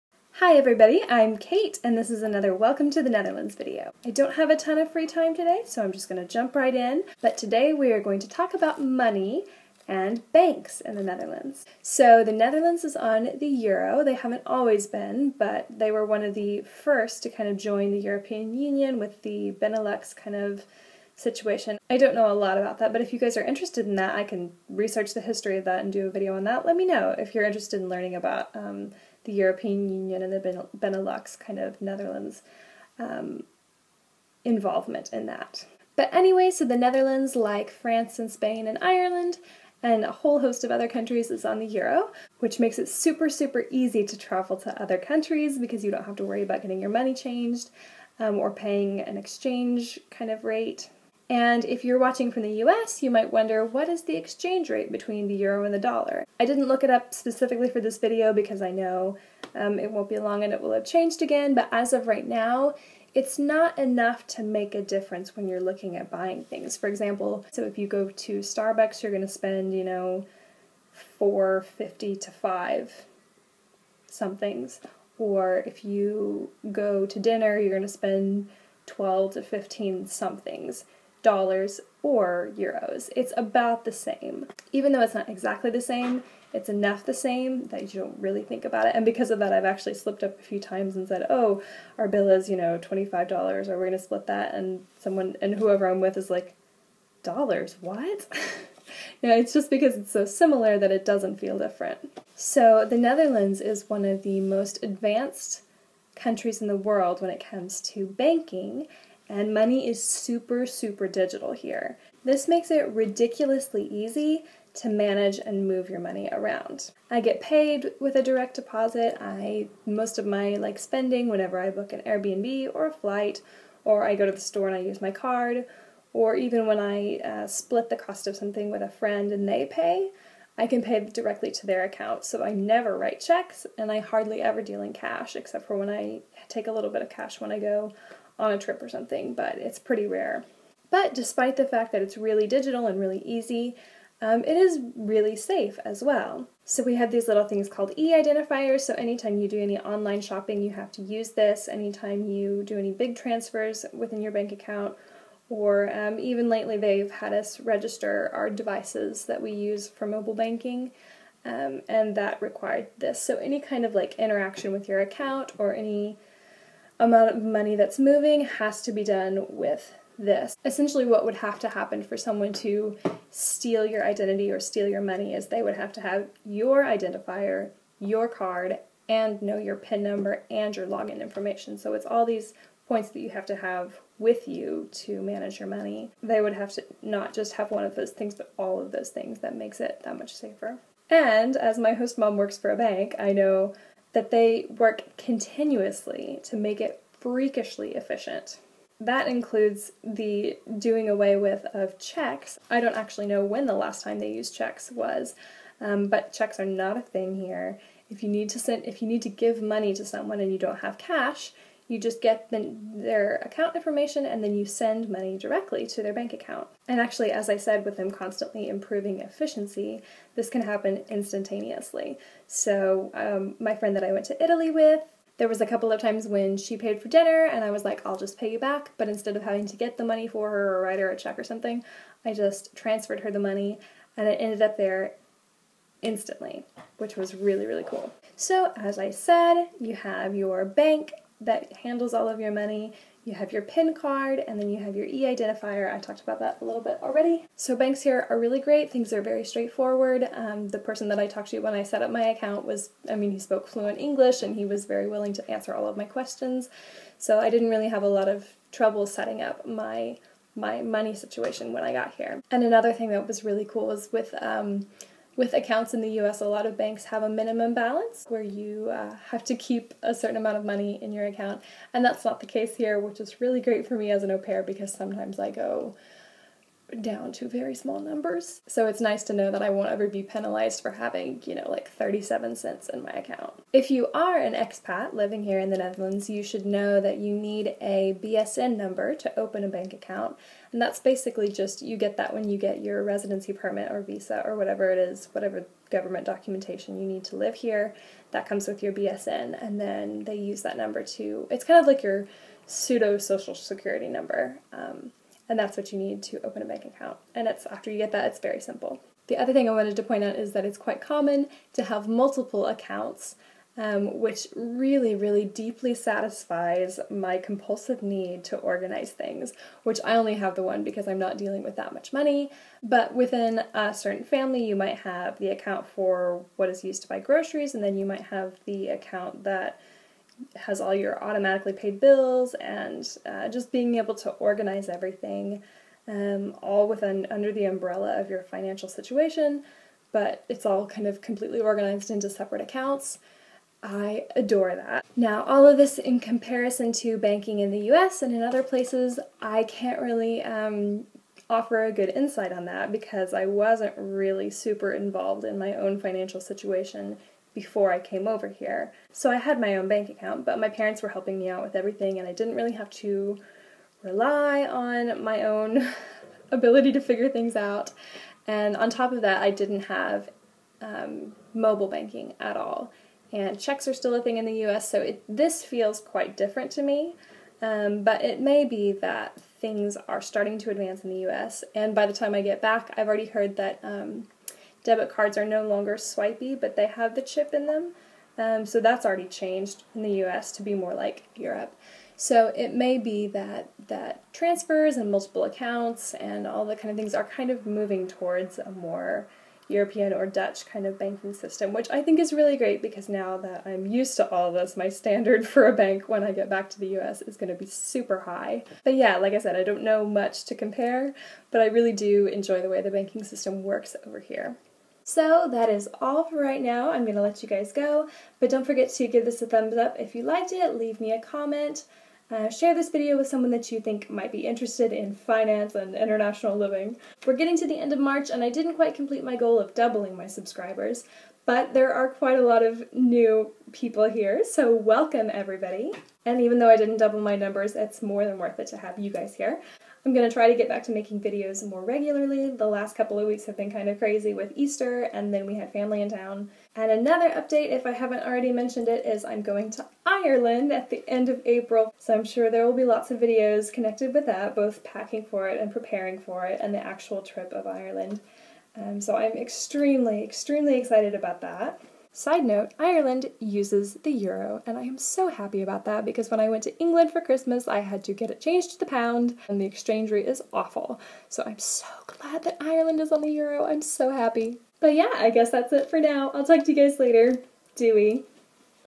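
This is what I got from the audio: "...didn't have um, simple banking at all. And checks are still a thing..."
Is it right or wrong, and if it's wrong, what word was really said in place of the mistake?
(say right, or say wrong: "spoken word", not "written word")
wrong: "mobile", not "simple".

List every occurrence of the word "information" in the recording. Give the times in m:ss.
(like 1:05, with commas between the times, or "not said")
3:01, 3:33.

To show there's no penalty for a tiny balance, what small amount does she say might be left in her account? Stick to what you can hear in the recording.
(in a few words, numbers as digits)
37 cents.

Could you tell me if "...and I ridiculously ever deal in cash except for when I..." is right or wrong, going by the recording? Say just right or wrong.
wrong.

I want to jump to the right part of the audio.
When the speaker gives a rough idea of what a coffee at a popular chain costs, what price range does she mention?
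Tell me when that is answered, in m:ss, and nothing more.
1:11.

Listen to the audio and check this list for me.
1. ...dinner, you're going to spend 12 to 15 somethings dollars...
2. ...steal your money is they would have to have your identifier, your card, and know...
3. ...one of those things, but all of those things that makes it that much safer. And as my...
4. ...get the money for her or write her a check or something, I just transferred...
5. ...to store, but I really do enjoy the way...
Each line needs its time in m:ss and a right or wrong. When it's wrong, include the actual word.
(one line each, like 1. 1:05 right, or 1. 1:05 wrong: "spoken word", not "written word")
1. 1:17 right
2. 2:54 right
3. 3:07 right
4. 3:49 right
5. 6:50 wrong: "compare", not "store".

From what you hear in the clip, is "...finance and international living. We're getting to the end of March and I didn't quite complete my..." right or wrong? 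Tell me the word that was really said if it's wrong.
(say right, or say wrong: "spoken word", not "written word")
right.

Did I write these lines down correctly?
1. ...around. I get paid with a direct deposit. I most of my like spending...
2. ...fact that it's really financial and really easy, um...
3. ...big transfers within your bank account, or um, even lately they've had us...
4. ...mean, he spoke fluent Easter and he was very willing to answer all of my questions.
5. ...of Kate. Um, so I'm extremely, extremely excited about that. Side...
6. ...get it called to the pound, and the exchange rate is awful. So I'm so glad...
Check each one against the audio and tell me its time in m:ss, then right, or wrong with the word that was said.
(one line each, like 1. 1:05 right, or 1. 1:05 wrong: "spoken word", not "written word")
1. 1:56 right
2. 2:21 wrong: "digital", not "financial"
3. 2:32 right
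4. 4:13 wrong: "English", not "Easter"
5. 7:37 wrong: "Ireland", not "Kate"
6. 7:48 wrong: "changed", not "called".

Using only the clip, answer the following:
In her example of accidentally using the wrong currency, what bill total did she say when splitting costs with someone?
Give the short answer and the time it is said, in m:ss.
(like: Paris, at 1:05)
25 dollars, at 1:32.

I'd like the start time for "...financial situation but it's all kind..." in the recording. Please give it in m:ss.
5:38.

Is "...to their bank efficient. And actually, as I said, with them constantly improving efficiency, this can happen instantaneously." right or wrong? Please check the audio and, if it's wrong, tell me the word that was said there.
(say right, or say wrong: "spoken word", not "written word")
wrong: "account", not "efficient".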